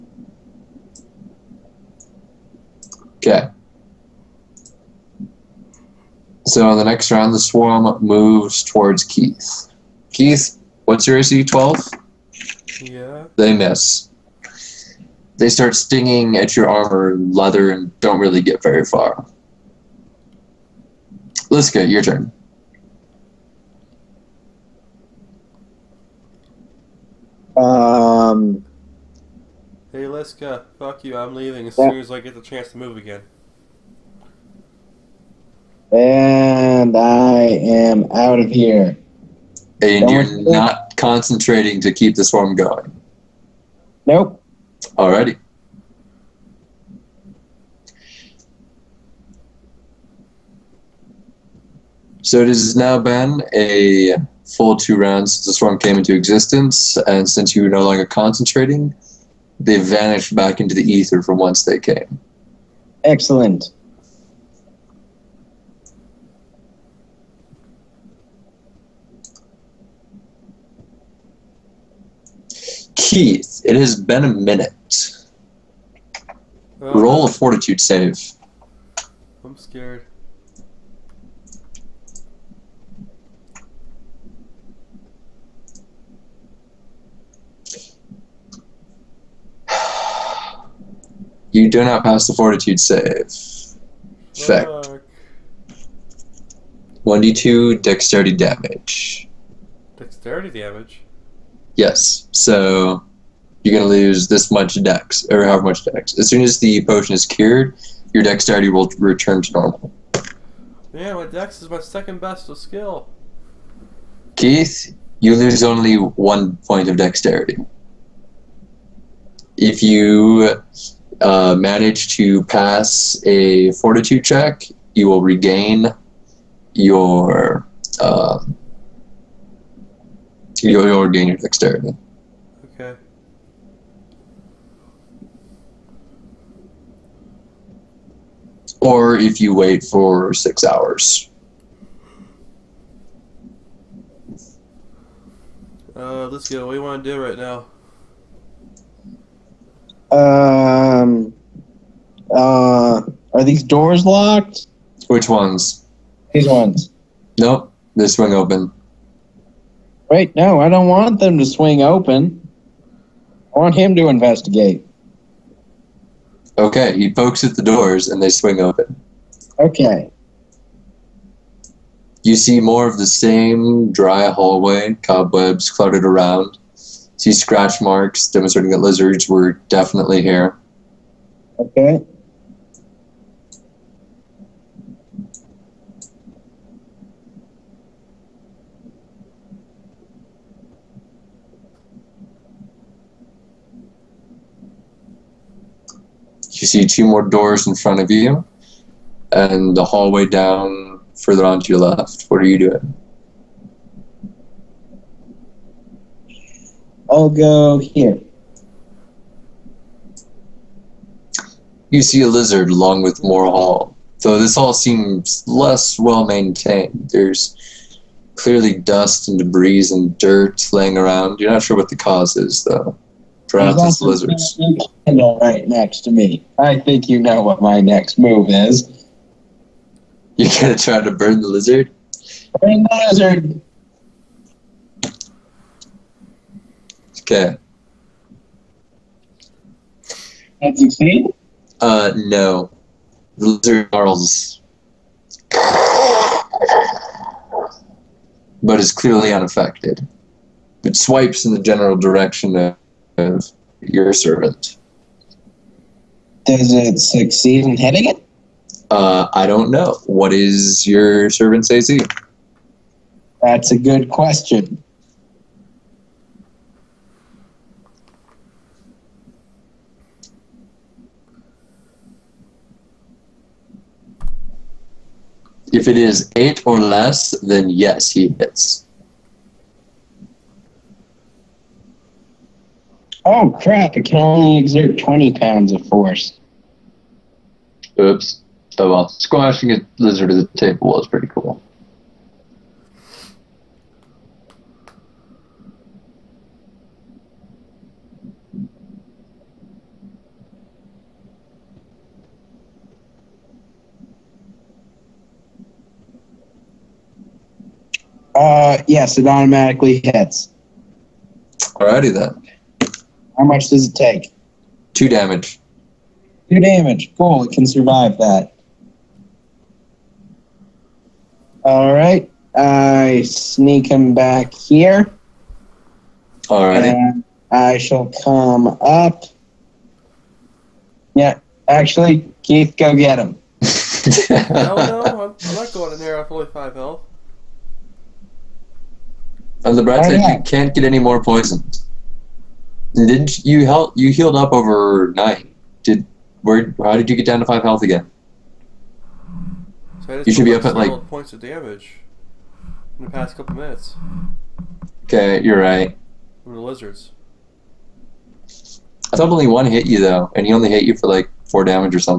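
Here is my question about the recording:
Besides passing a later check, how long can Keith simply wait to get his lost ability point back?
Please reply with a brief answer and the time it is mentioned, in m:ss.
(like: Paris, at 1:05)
6 hours, at 2:20.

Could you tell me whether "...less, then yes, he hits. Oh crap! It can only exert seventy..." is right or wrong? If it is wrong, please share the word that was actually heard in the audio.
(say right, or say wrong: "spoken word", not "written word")
wrong: "twenty", not "seventy".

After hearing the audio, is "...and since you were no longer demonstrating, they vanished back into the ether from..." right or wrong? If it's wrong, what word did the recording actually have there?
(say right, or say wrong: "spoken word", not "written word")
wrong: "concentrating", not "demonstrating".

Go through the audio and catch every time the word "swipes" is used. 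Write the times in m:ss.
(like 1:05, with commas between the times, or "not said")
4:10.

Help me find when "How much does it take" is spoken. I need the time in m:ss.
5:13.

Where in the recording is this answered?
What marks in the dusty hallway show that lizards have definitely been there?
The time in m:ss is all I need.
2:57.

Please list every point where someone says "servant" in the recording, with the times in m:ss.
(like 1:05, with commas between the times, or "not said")
4:14, 4:21.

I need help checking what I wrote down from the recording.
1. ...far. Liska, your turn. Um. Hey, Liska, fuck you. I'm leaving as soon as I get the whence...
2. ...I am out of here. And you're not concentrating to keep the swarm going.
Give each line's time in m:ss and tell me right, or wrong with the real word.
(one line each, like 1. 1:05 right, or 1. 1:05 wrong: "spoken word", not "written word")
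1. 0:18 wrong: "chance", not "whence"
2. 0:36 right.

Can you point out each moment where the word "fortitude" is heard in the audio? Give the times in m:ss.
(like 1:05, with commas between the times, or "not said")
1:17, 1:32, 2:03.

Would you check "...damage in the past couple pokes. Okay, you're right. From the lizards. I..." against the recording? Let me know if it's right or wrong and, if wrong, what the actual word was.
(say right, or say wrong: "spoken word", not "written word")
wrong: "minutes", not "pokes".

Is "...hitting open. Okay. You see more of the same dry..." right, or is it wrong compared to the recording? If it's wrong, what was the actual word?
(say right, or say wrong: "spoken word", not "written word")
wrong: "swing", not "hitting".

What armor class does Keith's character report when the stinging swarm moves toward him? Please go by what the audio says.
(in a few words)
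12.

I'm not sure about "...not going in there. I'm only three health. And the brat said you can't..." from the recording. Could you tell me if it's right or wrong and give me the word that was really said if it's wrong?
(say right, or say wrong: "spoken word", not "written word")
wrong: "five", not "three".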